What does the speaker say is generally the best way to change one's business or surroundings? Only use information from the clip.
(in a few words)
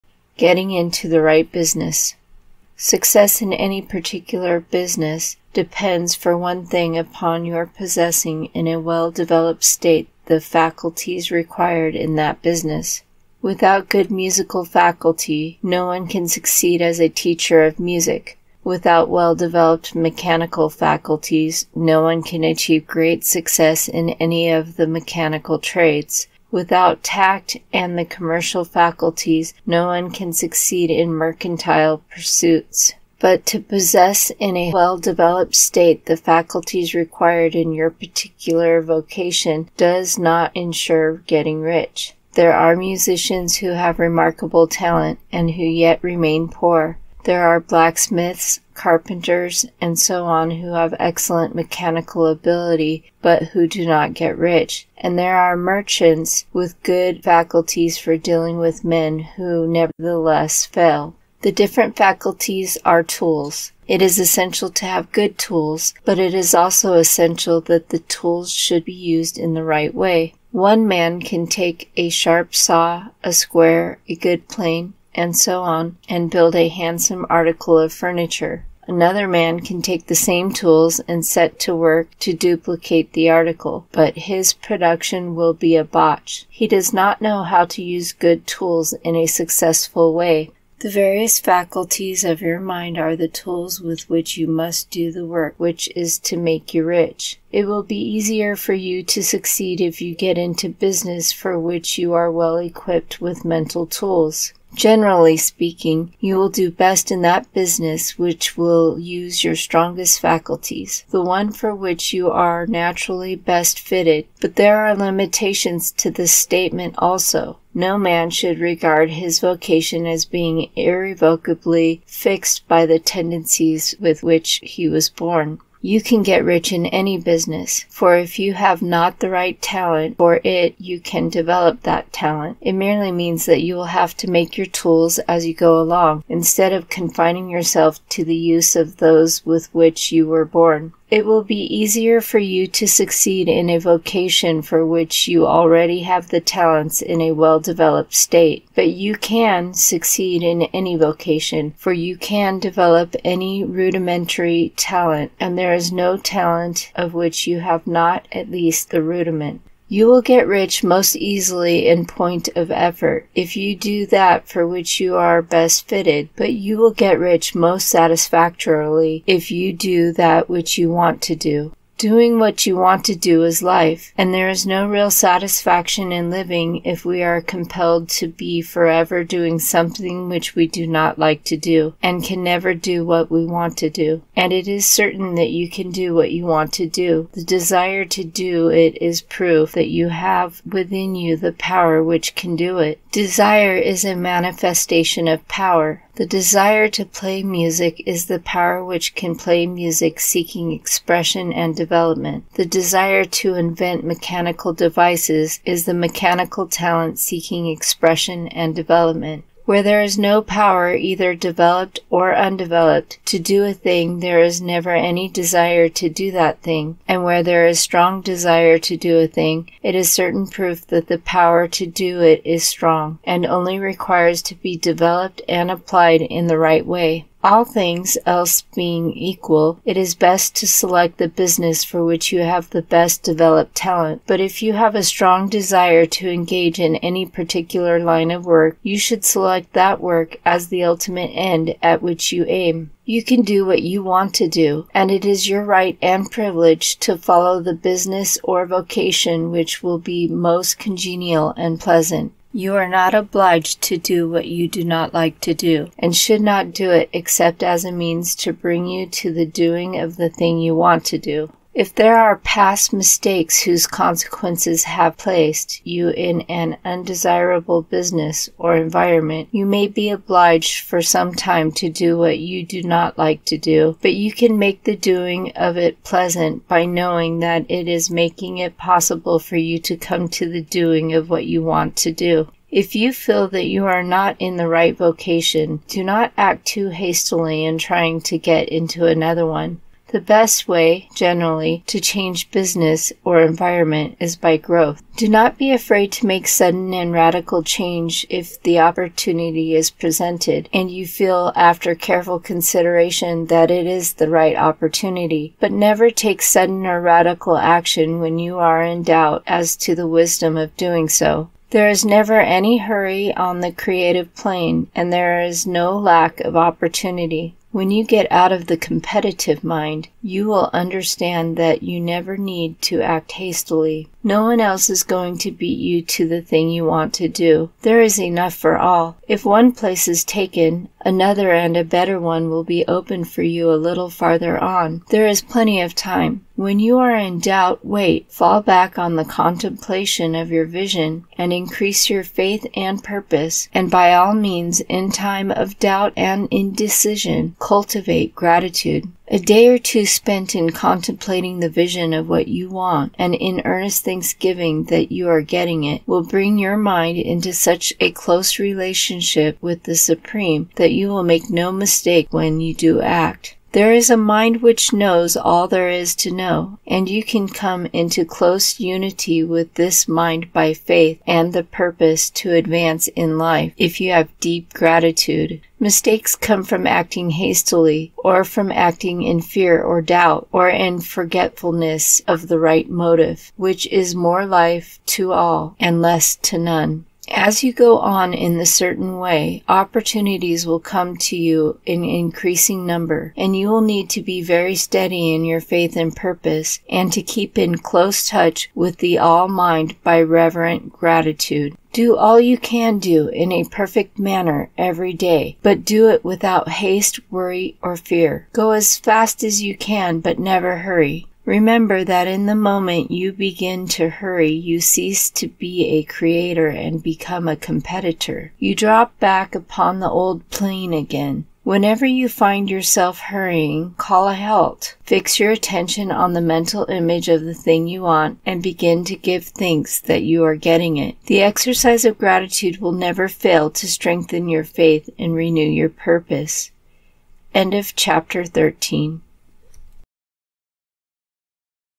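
by growth.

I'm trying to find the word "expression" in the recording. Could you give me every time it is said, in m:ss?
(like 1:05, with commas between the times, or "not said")
3:20, 3:27.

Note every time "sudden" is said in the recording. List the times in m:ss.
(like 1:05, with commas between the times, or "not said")
4:56, 5:06.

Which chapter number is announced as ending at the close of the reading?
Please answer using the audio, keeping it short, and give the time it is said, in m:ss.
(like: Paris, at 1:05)
13, at 7:17.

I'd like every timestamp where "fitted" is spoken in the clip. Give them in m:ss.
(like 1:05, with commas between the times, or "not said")
1:53, 2:45.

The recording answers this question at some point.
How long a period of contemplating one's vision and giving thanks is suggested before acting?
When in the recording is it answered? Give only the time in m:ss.
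5:49.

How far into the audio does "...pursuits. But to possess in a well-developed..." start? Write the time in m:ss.
0:32.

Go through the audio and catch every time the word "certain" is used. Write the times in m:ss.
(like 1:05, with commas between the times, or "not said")
3:04, 3:40, 6:28.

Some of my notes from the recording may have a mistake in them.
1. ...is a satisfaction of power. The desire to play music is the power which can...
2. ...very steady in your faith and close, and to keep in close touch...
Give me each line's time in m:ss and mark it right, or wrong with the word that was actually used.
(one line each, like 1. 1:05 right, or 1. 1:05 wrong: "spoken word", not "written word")
1. 3:13 wrong: "manifestation", not "satisfaction"
2. 6:34 wrong: "purpose", not "close".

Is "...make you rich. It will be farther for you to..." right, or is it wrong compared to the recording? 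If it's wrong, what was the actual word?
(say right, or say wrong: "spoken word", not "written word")
wrong: "easier", not "farther".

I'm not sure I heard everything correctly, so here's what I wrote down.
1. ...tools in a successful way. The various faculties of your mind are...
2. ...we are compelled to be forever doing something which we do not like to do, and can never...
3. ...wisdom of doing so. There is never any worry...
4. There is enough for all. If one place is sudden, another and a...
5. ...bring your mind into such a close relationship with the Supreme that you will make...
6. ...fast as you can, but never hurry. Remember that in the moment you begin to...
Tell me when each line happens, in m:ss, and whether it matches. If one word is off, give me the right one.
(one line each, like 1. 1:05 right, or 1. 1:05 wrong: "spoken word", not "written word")
1. 1:28 right
2. 2:57 right
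3. 5:10 wrong: "hurry", not "worry"
4. 5:27 wrong: "taken", not "sudden"
5. 5:56 right
6. 6:48 right.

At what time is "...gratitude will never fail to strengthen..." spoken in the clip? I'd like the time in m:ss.
7:12.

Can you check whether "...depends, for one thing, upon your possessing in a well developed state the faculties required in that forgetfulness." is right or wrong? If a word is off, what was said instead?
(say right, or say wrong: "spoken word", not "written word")
wrong: "business", not "forgetfulness".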